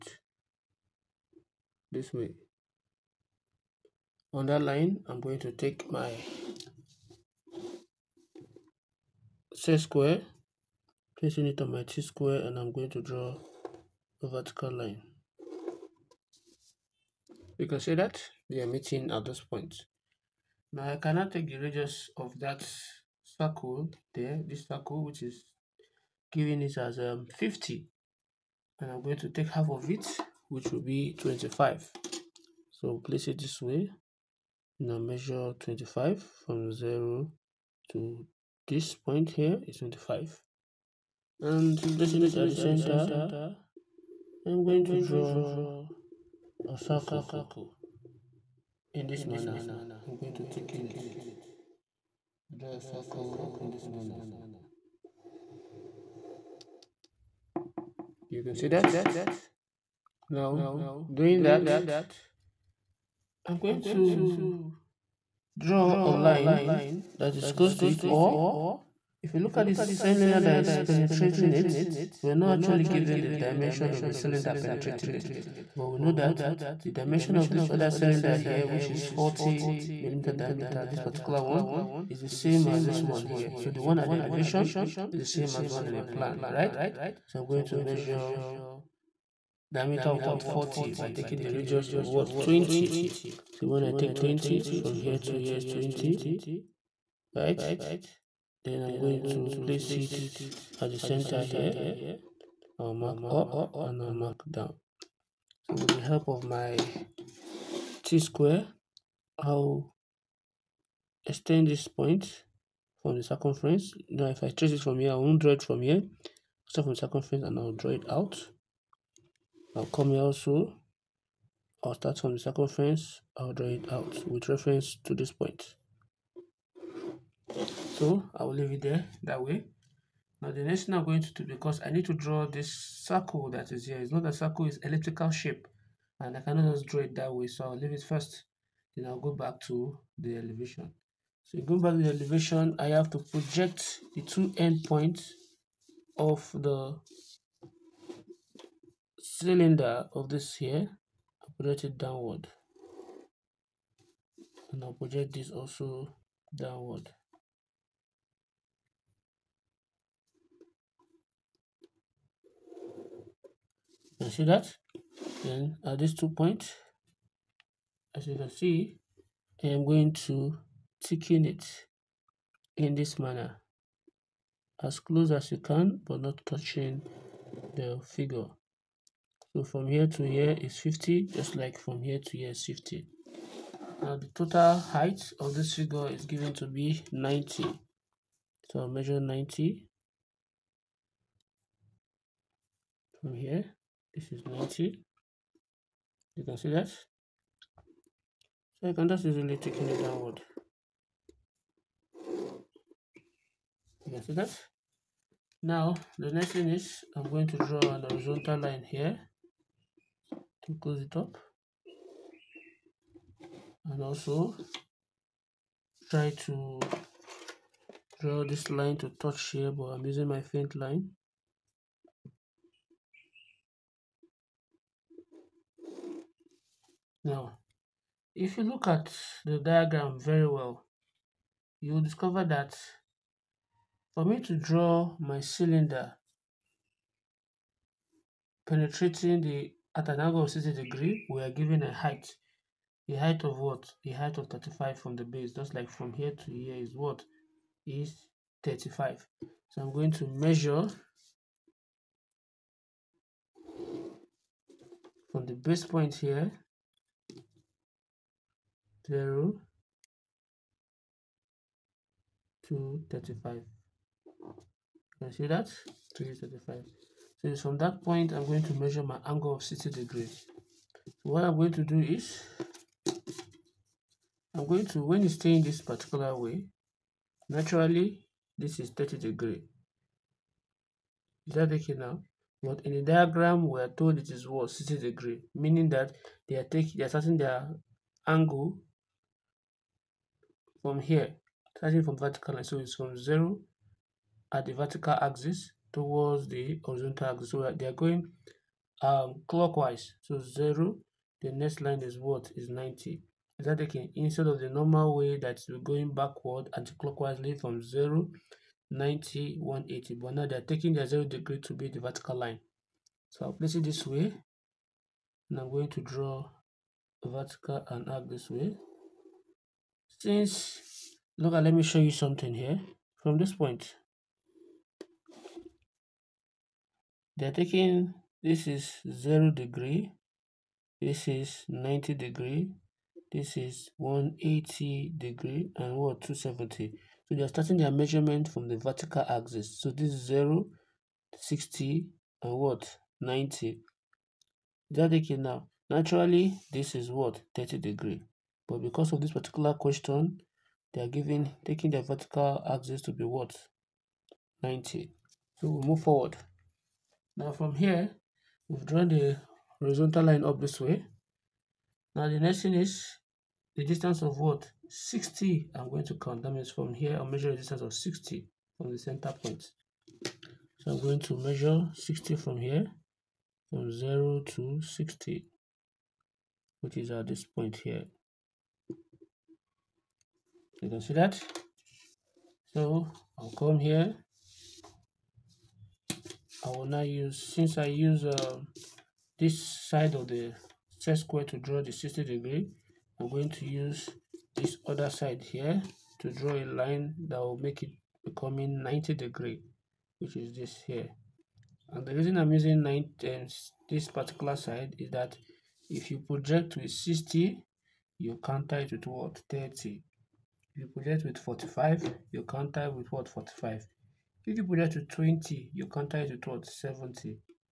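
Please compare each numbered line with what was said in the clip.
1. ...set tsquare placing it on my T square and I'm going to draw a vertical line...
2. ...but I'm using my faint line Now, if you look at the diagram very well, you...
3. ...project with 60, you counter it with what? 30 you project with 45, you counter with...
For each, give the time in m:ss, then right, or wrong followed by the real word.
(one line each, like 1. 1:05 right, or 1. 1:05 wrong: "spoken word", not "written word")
1. 0:09 wrong: "square", not "tsquare"
2. 3:39 right
3. 6:46 right.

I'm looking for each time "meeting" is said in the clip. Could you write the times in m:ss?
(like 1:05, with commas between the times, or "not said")
0:18.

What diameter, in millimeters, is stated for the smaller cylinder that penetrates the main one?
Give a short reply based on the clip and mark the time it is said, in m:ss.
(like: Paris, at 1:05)
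40 millimeter, at 1:19.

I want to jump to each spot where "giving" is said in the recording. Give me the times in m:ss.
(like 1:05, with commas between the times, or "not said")
0:26, 5:51.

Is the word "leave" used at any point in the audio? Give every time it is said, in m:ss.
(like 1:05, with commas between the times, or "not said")
2:08, 2:17.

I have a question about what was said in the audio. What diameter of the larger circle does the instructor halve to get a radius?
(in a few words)
50.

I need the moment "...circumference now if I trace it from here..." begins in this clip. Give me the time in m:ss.
1:53.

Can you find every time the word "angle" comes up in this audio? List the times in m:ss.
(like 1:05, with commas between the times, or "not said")
4:00, 4:29, 4:48.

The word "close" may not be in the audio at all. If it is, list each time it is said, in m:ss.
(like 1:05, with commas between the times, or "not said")
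1:07, 2:54, 3:30.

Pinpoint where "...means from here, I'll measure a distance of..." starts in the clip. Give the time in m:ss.
6:06.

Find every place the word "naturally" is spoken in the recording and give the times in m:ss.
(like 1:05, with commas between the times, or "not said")
4:37, 5:45.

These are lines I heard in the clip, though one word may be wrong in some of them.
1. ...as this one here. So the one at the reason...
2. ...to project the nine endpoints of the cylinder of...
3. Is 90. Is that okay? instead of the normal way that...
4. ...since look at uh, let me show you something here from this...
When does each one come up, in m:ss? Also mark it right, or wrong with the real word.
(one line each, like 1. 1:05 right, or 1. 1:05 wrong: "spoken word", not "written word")
1. 1:22 wrong: "elevation", not "reason"
2. 2:23 wrong: "two", not "nine"
3. 5:02 right
4. 5:20 right.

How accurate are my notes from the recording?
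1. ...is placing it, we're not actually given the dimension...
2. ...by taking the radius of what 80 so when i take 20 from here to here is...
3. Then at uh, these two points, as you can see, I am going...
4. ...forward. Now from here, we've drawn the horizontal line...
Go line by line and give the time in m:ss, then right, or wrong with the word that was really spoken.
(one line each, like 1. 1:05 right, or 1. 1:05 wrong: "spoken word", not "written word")
1. 1:10 wrong: "penetrating", not "placing"
2. 1:30 wrong: "20", not "80"
3. 2:45 right
4. 5:56 right.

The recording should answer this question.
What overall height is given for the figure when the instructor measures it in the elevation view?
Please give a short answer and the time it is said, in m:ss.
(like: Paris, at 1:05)
90, at 3:06.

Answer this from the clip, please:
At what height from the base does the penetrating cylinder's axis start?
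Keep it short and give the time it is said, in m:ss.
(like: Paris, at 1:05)
35, at 4:04.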